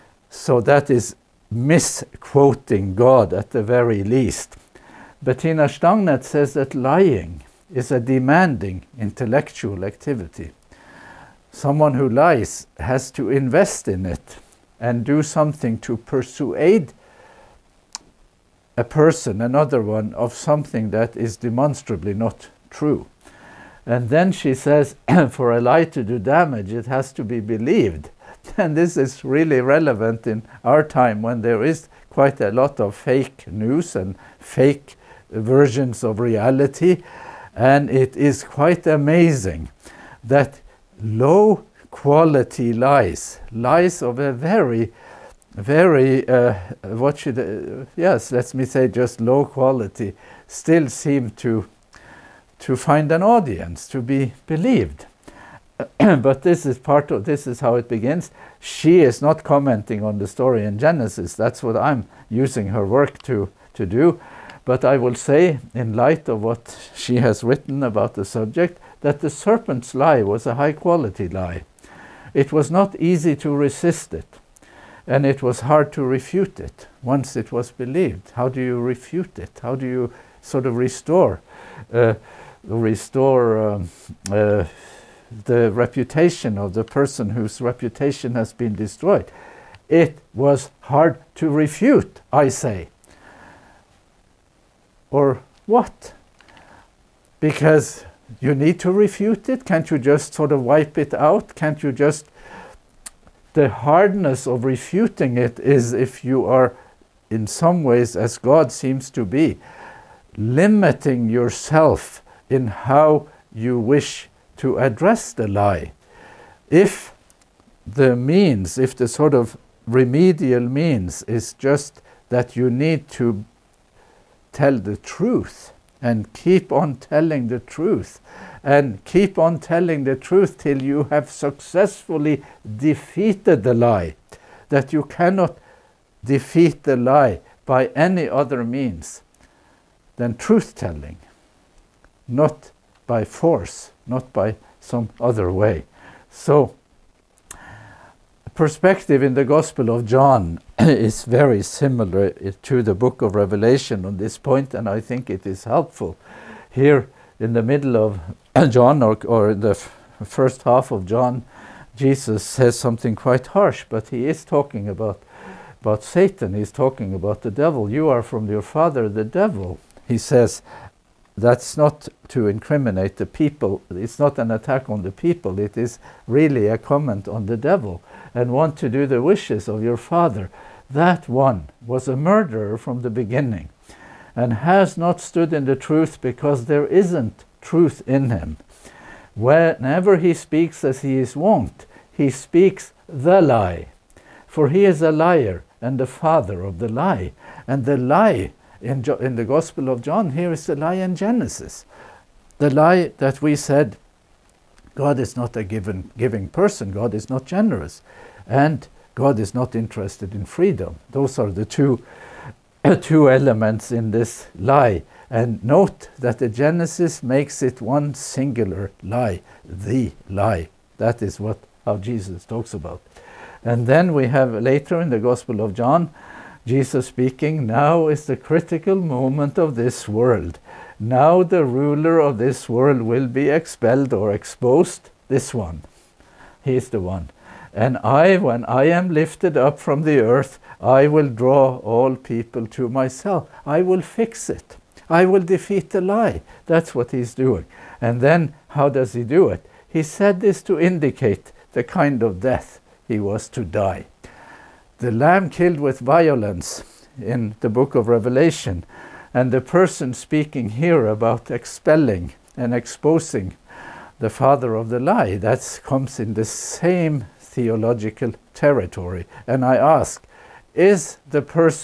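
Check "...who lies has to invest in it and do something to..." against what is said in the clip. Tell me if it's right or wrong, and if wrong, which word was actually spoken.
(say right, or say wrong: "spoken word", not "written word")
right.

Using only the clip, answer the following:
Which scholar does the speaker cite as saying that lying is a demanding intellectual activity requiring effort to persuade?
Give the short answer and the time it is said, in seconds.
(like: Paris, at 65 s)
Bettina Stangnet, at 5 s.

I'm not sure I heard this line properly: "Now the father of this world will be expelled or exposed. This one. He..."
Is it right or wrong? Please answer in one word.
wrong.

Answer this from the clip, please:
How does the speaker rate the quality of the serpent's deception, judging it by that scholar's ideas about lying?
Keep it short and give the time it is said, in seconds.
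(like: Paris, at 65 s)
high quality, at 70 s.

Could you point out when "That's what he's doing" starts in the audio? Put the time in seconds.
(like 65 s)
246 s.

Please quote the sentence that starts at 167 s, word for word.
You are from your father, the devil, he says, that's not to incriminate the people.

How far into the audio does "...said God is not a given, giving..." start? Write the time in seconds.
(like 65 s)
203 s.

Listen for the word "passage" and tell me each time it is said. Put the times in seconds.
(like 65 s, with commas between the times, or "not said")
not said.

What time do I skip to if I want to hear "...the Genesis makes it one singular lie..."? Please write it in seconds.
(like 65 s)
216 s.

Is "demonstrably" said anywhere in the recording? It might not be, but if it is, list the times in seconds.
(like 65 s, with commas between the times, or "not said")
21 s.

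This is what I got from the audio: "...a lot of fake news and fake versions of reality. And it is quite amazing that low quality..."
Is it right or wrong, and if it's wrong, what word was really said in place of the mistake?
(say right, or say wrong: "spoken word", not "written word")
right.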